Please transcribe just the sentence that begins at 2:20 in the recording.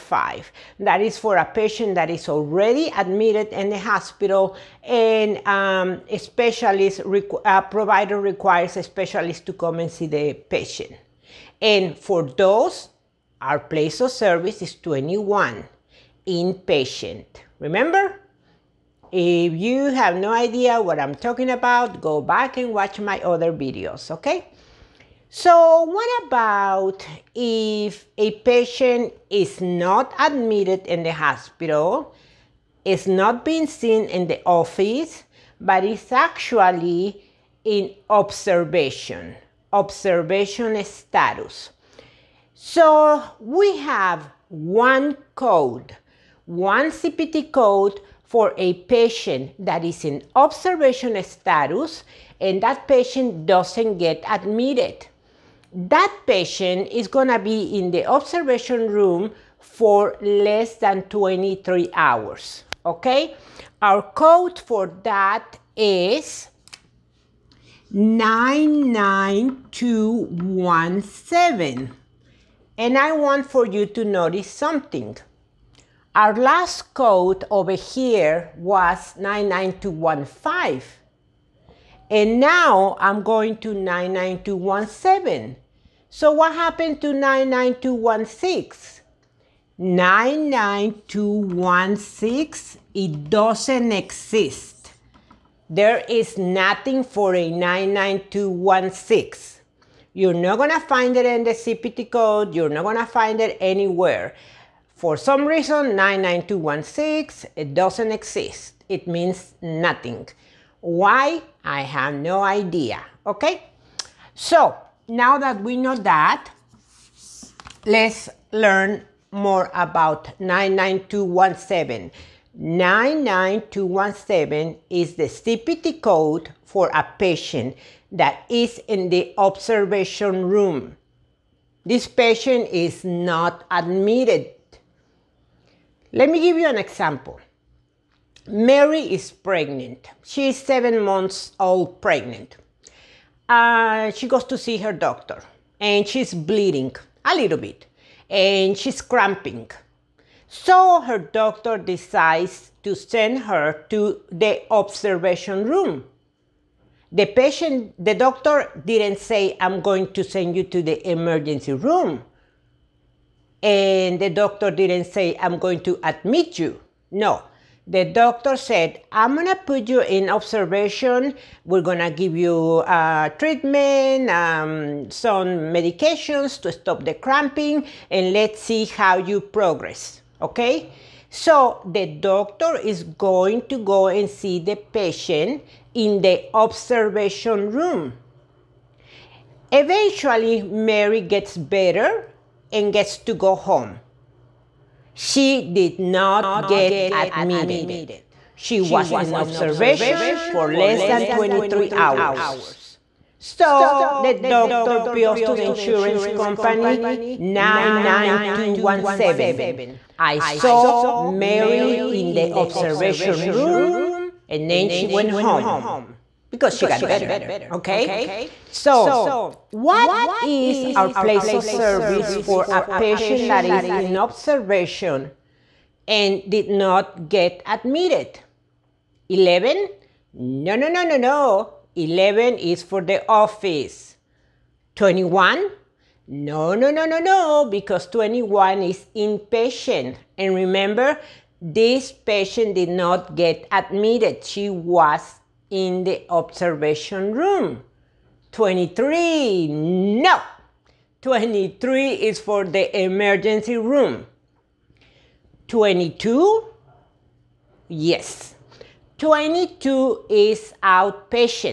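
She is seven months old pregnant.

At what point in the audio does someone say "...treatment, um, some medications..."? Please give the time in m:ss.
2:53.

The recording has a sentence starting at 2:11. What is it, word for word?
This patient is not admitted let me give you an example.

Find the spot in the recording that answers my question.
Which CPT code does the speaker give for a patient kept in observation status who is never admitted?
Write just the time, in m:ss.
1:03.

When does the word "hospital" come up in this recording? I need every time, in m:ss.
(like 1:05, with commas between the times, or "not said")
0:03, 0:31.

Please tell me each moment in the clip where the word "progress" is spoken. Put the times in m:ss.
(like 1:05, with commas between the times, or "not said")
2:59.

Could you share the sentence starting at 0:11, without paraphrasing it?
And for those, our place of service is 21, inpatient.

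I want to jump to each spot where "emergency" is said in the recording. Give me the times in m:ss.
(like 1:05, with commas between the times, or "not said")
2:41, 4:13.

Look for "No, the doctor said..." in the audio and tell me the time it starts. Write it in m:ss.
2:47.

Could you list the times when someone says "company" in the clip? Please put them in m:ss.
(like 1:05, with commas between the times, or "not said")
3:26.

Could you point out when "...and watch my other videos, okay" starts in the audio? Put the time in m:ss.
0:22.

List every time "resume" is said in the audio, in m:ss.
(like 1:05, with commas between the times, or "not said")
not said.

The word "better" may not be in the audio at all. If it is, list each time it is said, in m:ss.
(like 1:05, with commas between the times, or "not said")
3:11, 3:37.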